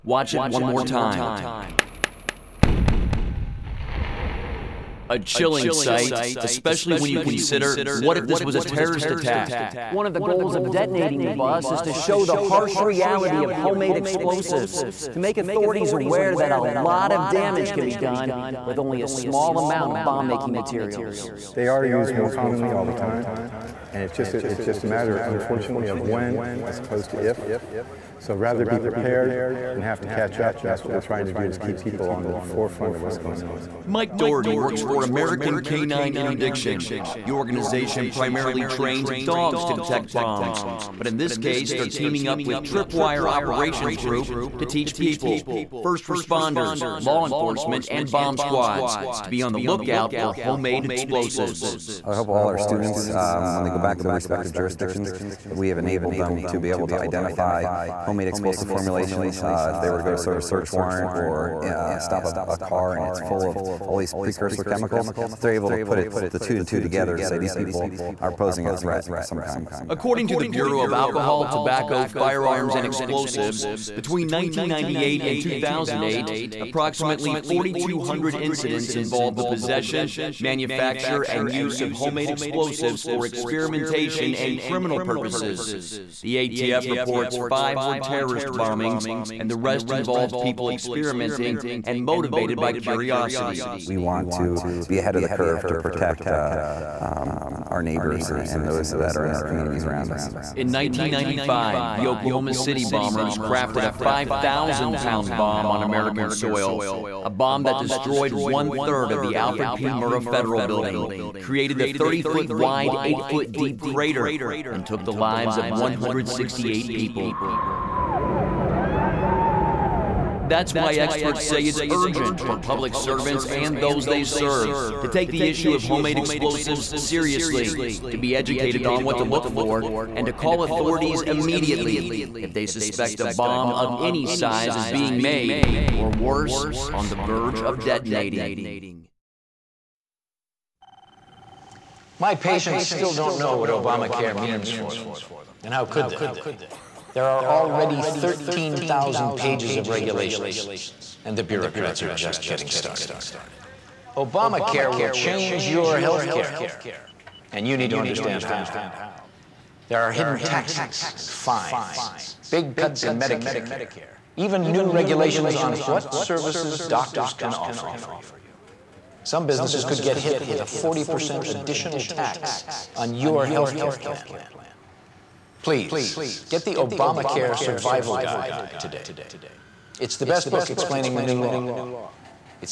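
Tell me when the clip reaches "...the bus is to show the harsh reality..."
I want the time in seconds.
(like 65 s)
11 s.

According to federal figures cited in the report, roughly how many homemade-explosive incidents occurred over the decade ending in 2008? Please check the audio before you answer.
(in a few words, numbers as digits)
4,200.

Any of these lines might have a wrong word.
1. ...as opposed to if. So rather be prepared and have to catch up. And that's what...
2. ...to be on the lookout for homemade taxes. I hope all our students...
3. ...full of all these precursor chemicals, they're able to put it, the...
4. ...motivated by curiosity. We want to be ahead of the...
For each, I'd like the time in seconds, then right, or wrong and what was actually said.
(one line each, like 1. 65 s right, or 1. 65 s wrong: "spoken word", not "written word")
1. 26 s right
2. 49 s wrong: "explosives", not "taxes"
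3. 63 s right
4. 92 s right.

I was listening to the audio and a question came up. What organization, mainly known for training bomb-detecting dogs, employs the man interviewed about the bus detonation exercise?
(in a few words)
American Canine Interdiction.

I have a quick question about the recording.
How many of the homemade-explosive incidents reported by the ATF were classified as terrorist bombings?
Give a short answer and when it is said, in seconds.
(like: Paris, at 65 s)
5, at 87 s.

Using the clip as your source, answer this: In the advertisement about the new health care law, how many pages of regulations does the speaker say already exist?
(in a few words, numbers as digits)
13,000.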